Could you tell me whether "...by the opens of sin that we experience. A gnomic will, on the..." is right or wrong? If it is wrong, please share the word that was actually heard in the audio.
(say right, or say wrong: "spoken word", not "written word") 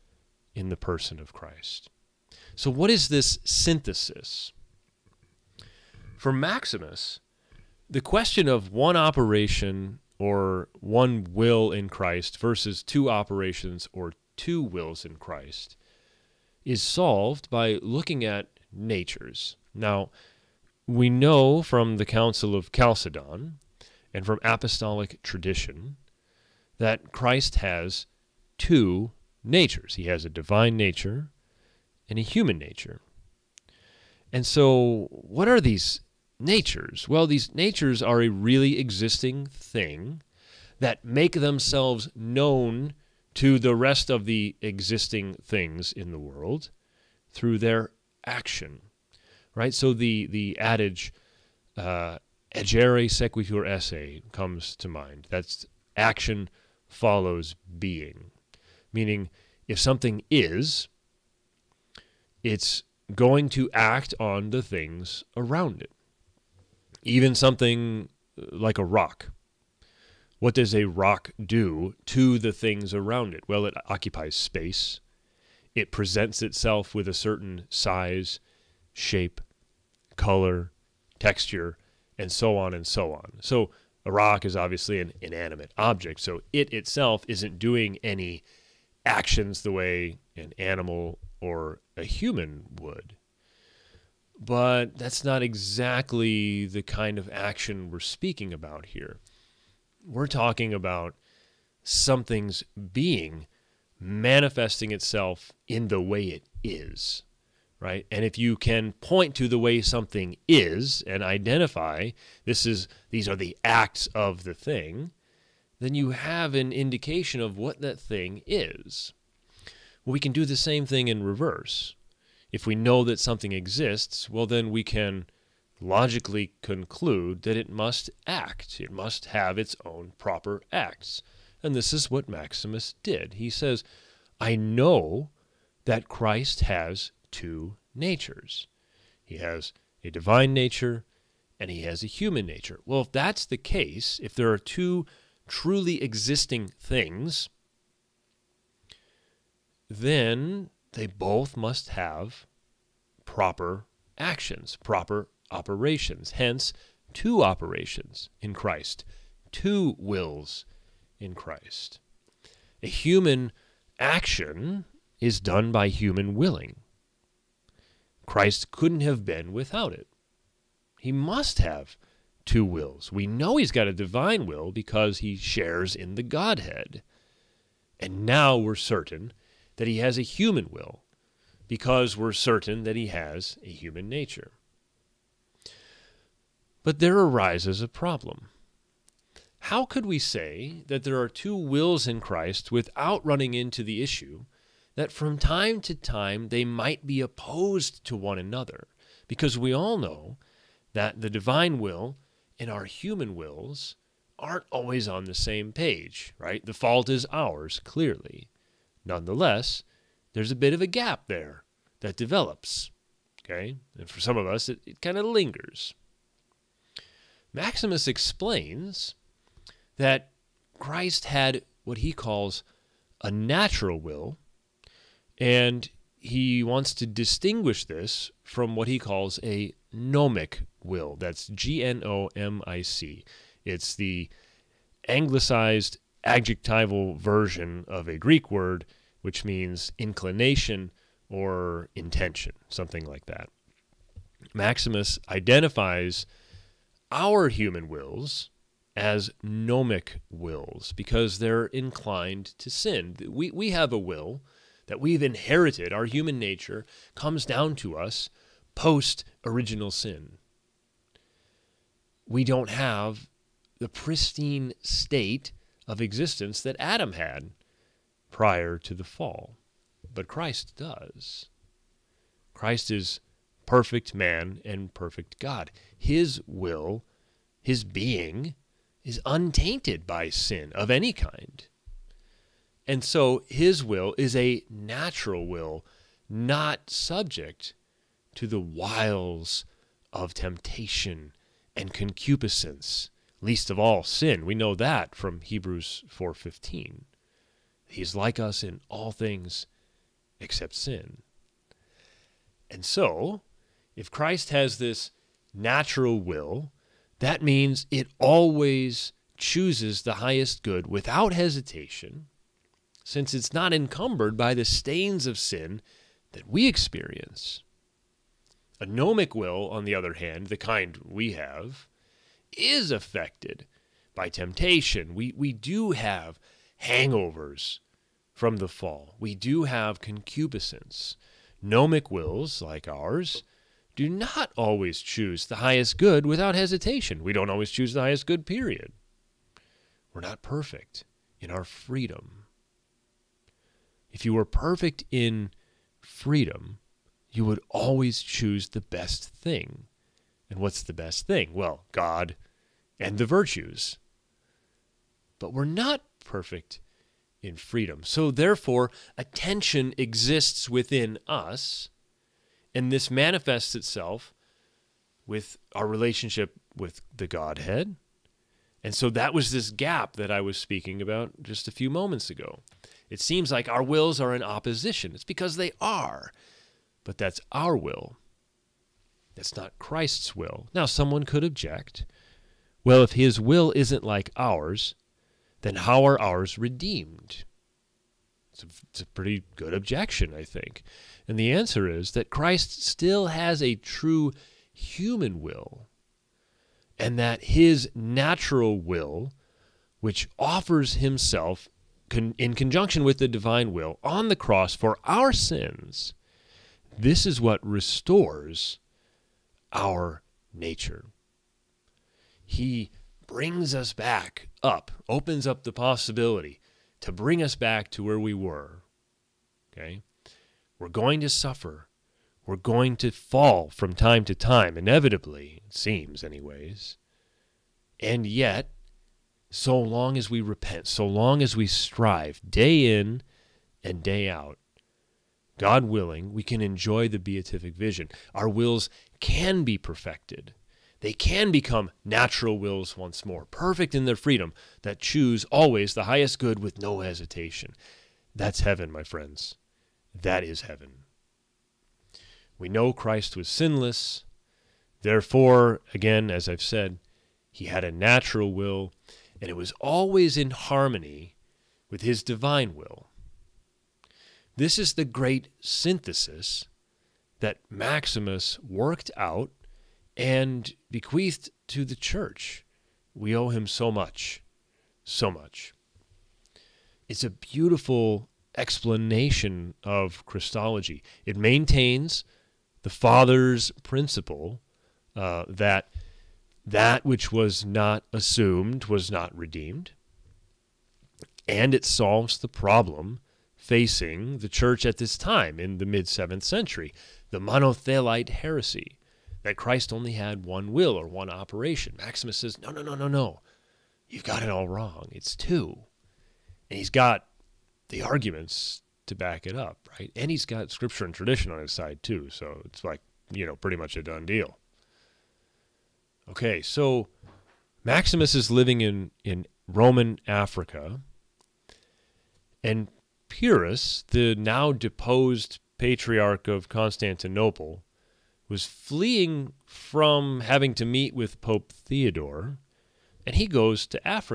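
wrong: "stains", not "opens".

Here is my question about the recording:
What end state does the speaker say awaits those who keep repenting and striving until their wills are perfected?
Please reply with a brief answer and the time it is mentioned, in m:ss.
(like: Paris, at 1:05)
The beatific vision, at 7:17.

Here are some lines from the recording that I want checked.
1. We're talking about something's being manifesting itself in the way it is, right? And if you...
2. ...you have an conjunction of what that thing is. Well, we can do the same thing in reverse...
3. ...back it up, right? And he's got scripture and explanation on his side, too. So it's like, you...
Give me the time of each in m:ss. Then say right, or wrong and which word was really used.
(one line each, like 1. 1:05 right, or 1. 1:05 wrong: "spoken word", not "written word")
1. 1:40 right
2. 1:55 wrong: "indication", not "conjunction"
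3. 8:29 wrong: "tradition", not "explanation".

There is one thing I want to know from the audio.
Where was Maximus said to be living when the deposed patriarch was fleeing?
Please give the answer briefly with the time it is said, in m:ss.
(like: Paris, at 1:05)
Roman Africa, at 8:39.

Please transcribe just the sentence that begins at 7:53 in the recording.
We owe him so much, so much.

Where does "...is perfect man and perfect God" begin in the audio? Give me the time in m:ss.
4:32.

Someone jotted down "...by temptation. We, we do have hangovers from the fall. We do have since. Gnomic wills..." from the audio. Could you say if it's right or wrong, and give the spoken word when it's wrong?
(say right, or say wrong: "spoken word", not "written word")
wrong: "concupiscence", not "since".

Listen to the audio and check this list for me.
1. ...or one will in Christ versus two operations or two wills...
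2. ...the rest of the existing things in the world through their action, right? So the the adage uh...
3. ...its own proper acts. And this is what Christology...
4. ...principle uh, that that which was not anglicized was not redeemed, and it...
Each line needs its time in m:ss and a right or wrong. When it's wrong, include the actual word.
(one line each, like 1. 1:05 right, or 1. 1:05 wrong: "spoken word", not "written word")
1. 0:10 right
2. 0:43 right
3. 2:09 wrong: "Maximus", not "Christology"
4. 8:03 wrong: "assumed", not "anglicized".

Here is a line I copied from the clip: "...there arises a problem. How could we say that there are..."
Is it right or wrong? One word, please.
right.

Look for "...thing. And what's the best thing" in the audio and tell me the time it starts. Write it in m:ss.
5:49.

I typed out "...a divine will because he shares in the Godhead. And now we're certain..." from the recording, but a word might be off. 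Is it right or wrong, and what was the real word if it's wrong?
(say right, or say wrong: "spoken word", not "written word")
right.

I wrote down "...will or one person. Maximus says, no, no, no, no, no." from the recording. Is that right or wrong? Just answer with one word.
wrong.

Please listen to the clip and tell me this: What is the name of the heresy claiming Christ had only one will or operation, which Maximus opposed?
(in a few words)
Monothelite heresy.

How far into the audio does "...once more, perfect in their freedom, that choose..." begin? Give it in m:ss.
7:22.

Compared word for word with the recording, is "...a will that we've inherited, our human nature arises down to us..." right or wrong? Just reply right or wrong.
wrong.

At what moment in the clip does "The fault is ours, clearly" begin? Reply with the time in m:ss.
3:26.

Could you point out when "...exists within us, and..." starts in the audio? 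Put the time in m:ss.
5:59.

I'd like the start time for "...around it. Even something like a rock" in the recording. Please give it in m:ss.
1:05.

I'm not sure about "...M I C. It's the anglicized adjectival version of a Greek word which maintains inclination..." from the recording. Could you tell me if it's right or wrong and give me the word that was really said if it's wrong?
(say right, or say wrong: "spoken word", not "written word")
wrong: "means", not "maintains".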